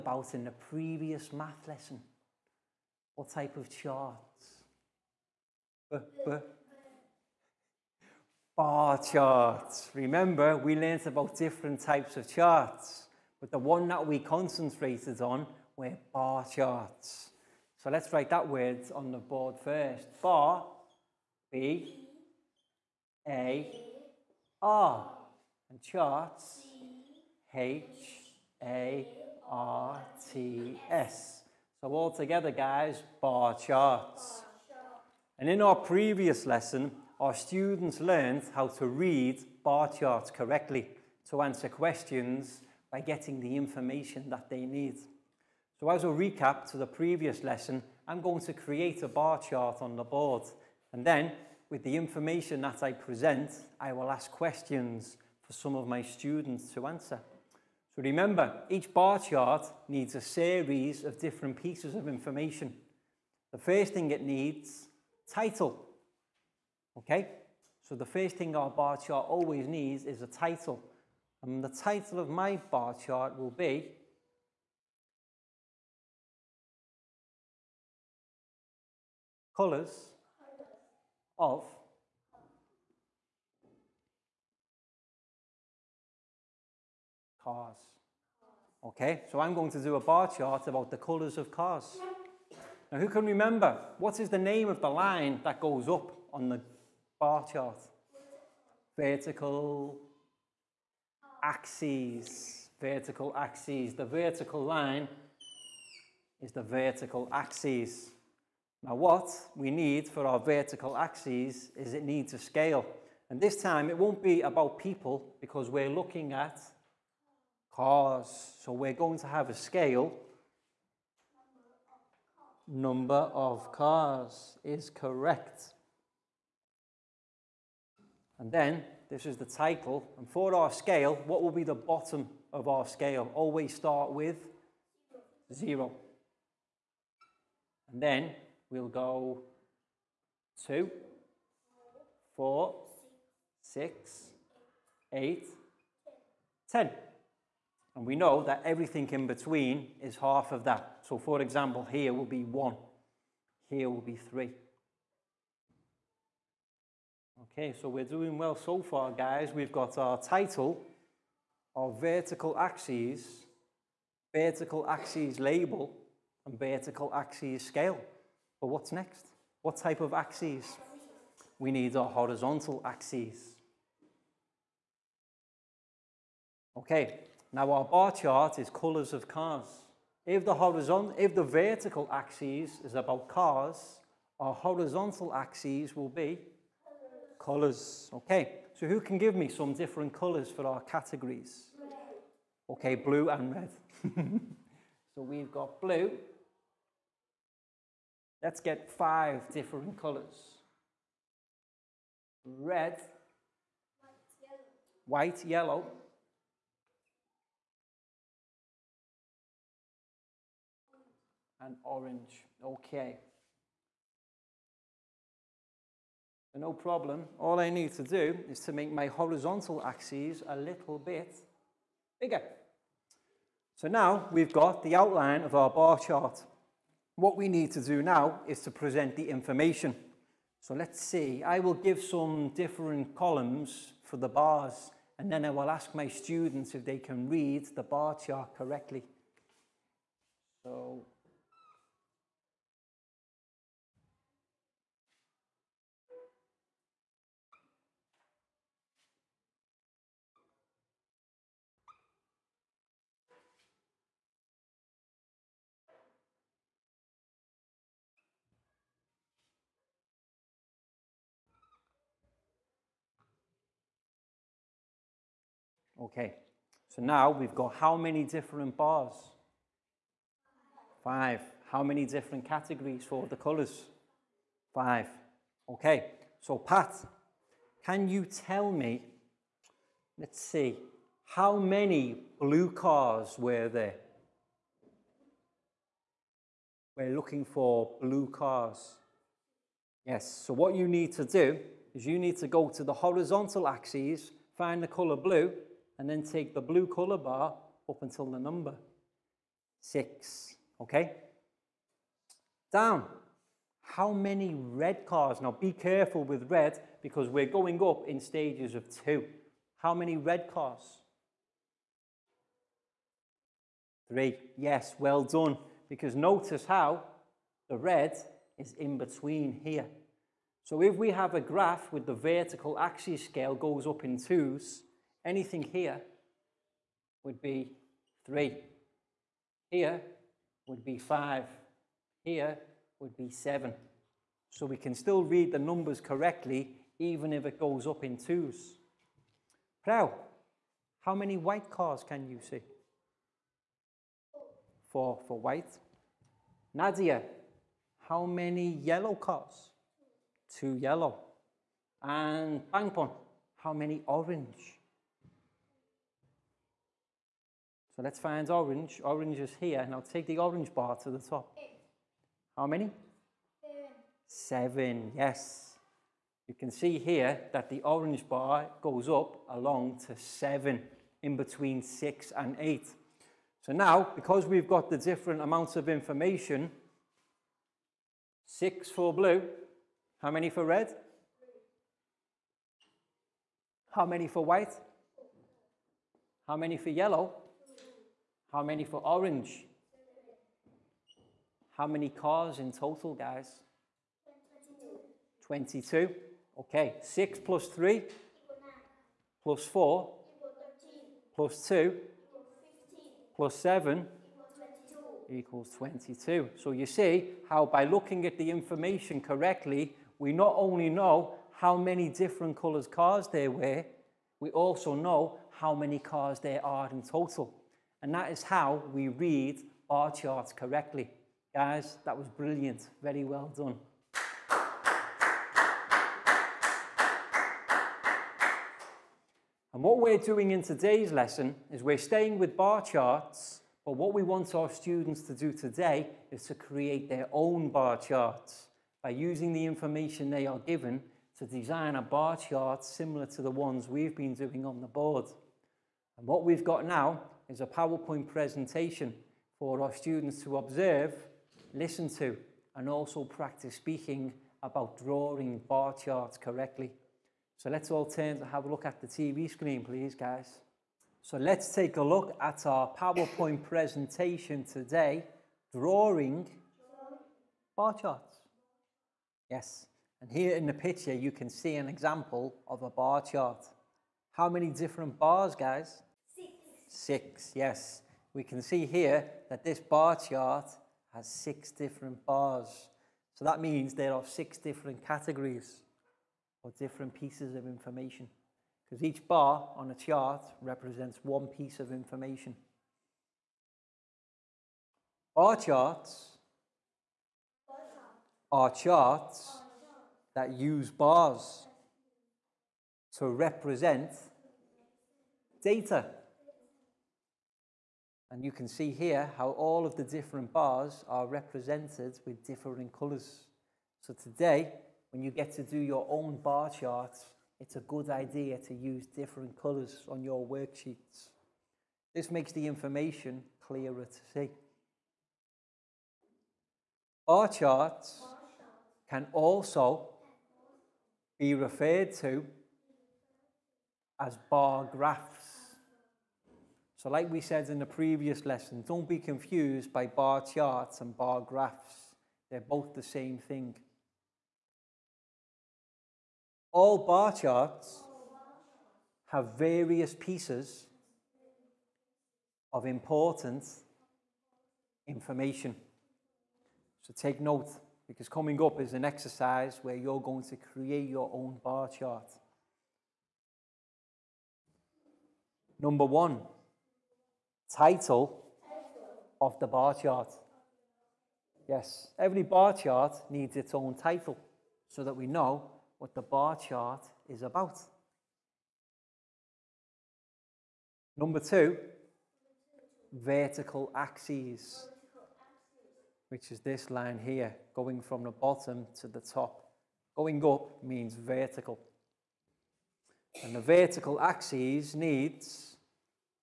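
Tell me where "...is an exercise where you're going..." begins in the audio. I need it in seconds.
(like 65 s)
558 s.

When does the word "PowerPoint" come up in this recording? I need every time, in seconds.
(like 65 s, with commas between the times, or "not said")
447 s, 462 s.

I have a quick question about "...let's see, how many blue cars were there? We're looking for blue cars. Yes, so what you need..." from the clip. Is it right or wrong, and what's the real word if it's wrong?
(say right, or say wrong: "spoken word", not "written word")
right.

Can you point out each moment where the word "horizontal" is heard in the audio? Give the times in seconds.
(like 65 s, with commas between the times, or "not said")
172 s, 180 s, 184 s, 219 s, 292 s.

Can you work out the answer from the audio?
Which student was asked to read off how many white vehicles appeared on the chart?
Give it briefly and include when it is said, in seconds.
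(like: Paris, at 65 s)
Prao, at 339 s.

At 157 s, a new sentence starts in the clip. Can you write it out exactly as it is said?
Okay, so we're doing well so far, guys.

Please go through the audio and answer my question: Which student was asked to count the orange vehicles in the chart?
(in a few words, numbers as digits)
Bangpon.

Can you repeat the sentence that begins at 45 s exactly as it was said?
So as a recap to the previous lesson, I'm going to create a bar chart on the board.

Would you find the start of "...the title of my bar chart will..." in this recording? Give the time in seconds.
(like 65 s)
71 s.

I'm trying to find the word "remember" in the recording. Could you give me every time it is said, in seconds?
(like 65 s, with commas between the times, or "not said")
9 s, 58 s, 93 s.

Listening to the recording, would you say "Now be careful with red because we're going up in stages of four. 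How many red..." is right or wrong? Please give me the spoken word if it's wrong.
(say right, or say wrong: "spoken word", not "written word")
wrong: "two", not "four".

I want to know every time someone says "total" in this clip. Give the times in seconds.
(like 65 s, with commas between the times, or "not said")
392 s, 417 s.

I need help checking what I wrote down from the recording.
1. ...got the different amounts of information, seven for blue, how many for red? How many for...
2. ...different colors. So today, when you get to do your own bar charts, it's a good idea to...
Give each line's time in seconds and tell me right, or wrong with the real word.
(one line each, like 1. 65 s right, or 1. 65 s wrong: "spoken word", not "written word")
1. 374 s wrong: "six", not "seven"
2. 512 s right.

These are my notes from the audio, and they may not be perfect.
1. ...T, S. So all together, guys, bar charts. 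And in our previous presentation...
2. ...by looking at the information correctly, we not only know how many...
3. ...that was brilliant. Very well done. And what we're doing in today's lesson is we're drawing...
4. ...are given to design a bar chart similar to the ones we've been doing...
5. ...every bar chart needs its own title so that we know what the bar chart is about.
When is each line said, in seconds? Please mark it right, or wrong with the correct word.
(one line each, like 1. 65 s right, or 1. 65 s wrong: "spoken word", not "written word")
1. 30 s wrong: "lesson", not "presentation"
2. 407 s right
3. 422 s wrong: "staying", not "drawing"
4. 440 s right
5. 572 s right.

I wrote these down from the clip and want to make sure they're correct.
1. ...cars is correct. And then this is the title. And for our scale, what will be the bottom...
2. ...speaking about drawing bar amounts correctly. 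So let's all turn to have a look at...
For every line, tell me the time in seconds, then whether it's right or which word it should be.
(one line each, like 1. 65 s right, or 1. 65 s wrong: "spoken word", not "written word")
1. 123 s right
2. 453 s wrong: "charts", not "amounts".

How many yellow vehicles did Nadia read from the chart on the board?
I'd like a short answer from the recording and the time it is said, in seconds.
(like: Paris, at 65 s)
2, at 350 s.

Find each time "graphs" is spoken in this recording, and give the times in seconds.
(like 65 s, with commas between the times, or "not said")
321 s, 534 s, 541 s.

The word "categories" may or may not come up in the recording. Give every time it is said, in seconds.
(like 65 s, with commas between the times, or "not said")
190 s, 272 s, 485 s.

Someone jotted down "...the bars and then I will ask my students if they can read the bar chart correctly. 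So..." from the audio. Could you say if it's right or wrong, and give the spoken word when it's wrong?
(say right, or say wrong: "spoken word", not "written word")
right.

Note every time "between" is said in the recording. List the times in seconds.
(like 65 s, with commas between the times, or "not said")
149 s, 318 s, 371 s.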